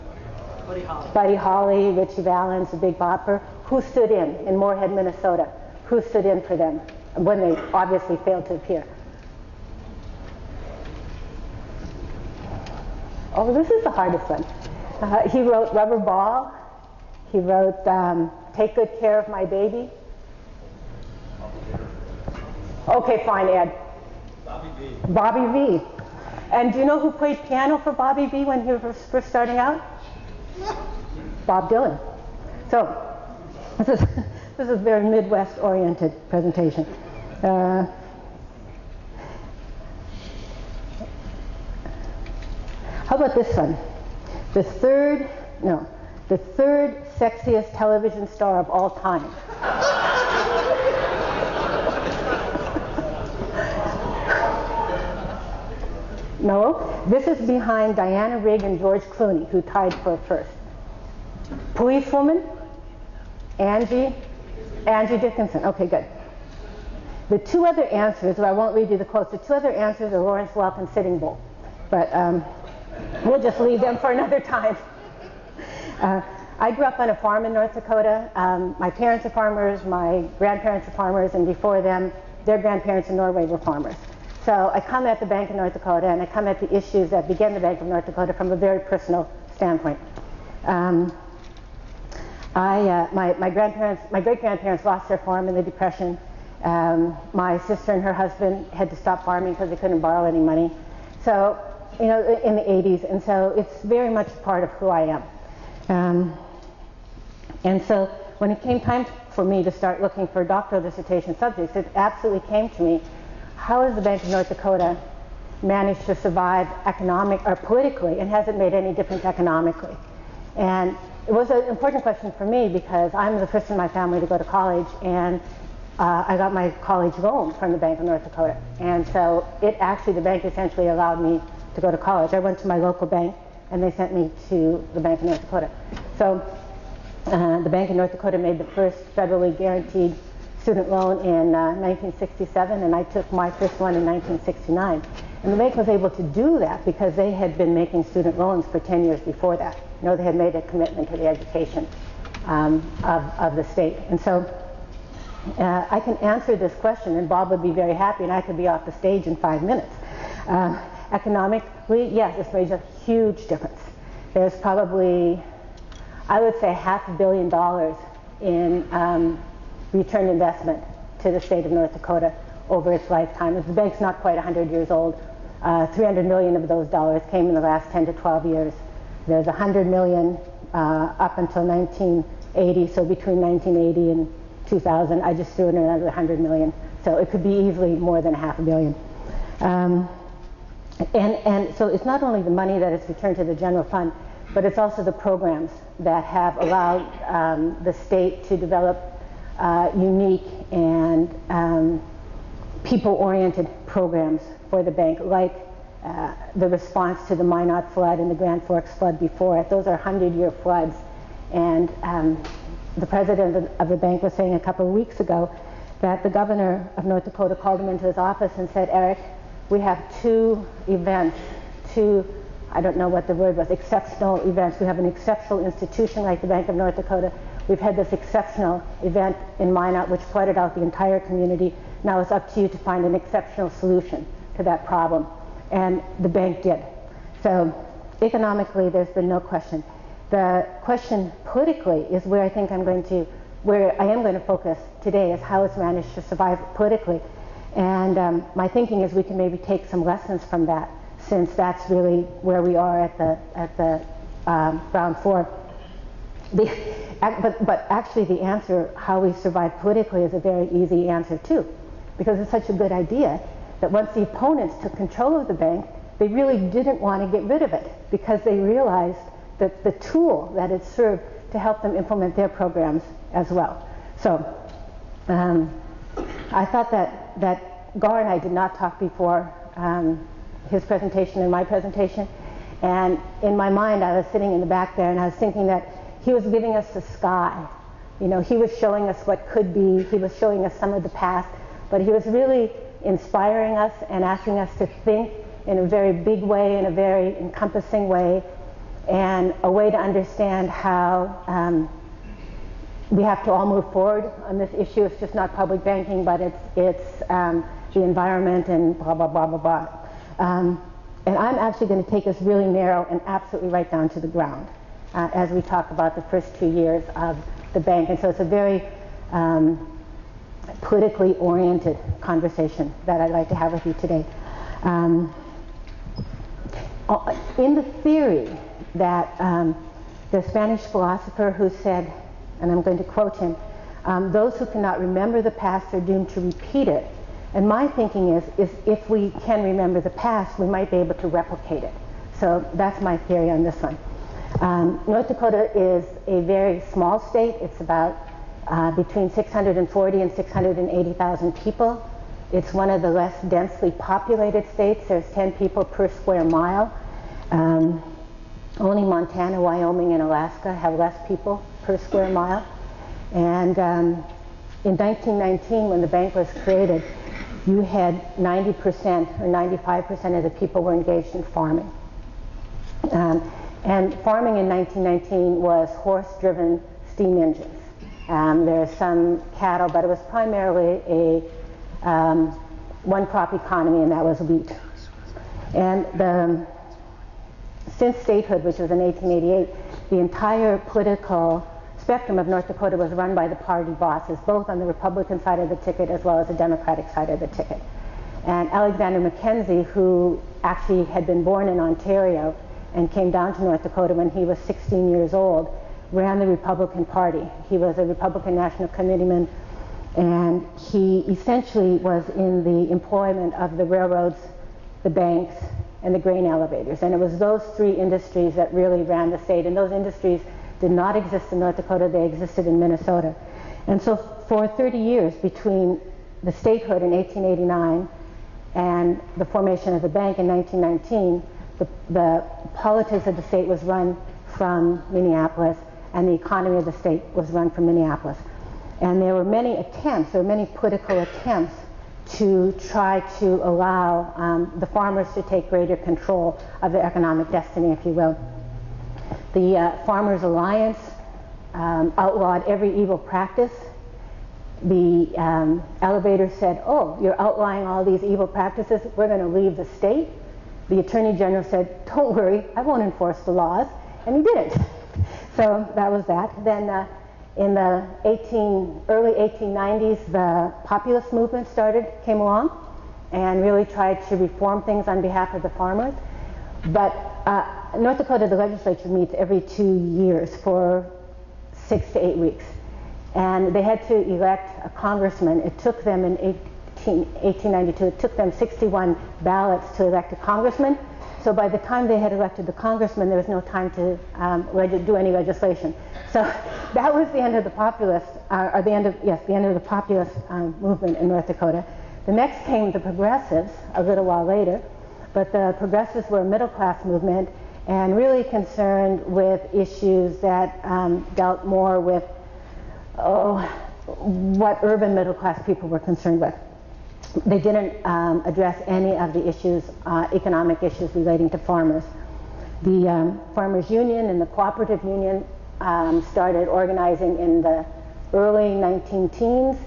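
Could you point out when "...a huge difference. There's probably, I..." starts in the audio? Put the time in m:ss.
2:42.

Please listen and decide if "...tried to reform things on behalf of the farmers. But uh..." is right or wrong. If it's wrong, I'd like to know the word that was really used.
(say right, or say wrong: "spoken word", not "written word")
right.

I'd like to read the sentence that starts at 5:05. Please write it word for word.
It's just not public banking, but it's it's um, the environment and blah blah blah blah blah.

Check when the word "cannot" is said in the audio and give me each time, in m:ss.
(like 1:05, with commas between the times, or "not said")
5:34.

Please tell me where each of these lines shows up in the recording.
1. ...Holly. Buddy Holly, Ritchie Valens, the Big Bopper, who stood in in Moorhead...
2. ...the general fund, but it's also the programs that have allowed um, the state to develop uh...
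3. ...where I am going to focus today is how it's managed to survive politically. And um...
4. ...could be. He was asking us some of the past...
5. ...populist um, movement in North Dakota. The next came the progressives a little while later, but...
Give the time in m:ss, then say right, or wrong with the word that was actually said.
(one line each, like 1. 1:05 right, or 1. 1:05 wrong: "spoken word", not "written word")
1. 0:00 right
2. 3:13 right
3. 4:03 right
4. 4:49 wrong: "showing", not "asking"
5. 8:19 right.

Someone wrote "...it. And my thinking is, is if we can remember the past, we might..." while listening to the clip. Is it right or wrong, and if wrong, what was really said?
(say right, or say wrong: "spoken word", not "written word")
right.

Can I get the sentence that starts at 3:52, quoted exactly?
Now it's up to you to find an exceptional solution to that problem.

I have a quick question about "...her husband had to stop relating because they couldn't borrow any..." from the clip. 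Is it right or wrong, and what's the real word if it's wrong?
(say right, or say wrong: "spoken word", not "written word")
wrong: "farming", not "relating".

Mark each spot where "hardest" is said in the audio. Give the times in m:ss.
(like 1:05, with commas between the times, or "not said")
0:13.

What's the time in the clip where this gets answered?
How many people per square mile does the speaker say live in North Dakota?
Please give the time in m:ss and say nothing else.
5:55.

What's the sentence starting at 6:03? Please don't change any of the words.
And um, in 1919, when the bank was created, you had 90% or 95% of the people were engaged in farming.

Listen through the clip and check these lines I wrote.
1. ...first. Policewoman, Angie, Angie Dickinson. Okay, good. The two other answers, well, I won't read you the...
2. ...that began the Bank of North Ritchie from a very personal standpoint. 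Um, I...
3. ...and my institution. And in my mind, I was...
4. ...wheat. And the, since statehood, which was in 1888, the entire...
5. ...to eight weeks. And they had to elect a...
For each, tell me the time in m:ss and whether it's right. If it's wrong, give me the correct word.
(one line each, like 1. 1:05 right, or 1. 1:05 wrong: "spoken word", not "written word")
1. 1:00 right
2. 1:27 wrong: "Dakota", not "Ritchie"
3. 4:41 wrong: "presentation", not "institution"
4. 6:24 right
5. 8:02 right.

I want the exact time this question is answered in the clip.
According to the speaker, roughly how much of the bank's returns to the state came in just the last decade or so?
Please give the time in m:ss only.
2:55.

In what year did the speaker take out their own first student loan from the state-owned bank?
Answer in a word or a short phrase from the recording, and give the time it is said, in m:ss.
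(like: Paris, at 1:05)
1969, at 2:24.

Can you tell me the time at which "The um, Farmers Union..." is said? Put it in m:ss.
8:42.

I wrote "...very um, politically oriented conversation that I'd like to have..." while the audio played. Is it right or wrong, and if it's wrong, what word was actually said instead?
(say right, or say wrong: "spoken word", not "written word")
right.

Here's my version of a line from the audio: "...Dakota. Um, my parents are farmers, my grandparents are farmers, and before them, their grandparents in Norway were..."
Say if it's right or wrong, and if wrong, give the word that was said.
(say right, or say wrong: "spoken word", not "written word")
right.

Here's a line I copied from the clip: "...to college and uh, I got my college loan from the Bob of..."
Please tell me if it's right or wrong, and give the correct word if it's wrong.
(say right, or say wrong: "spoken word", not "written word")
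wrong: "Bank", not "Bob".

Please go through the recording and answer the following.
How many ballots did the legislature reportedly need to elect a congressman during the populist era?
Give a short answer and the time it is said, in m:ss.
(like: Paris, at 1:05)
61, at 8:08.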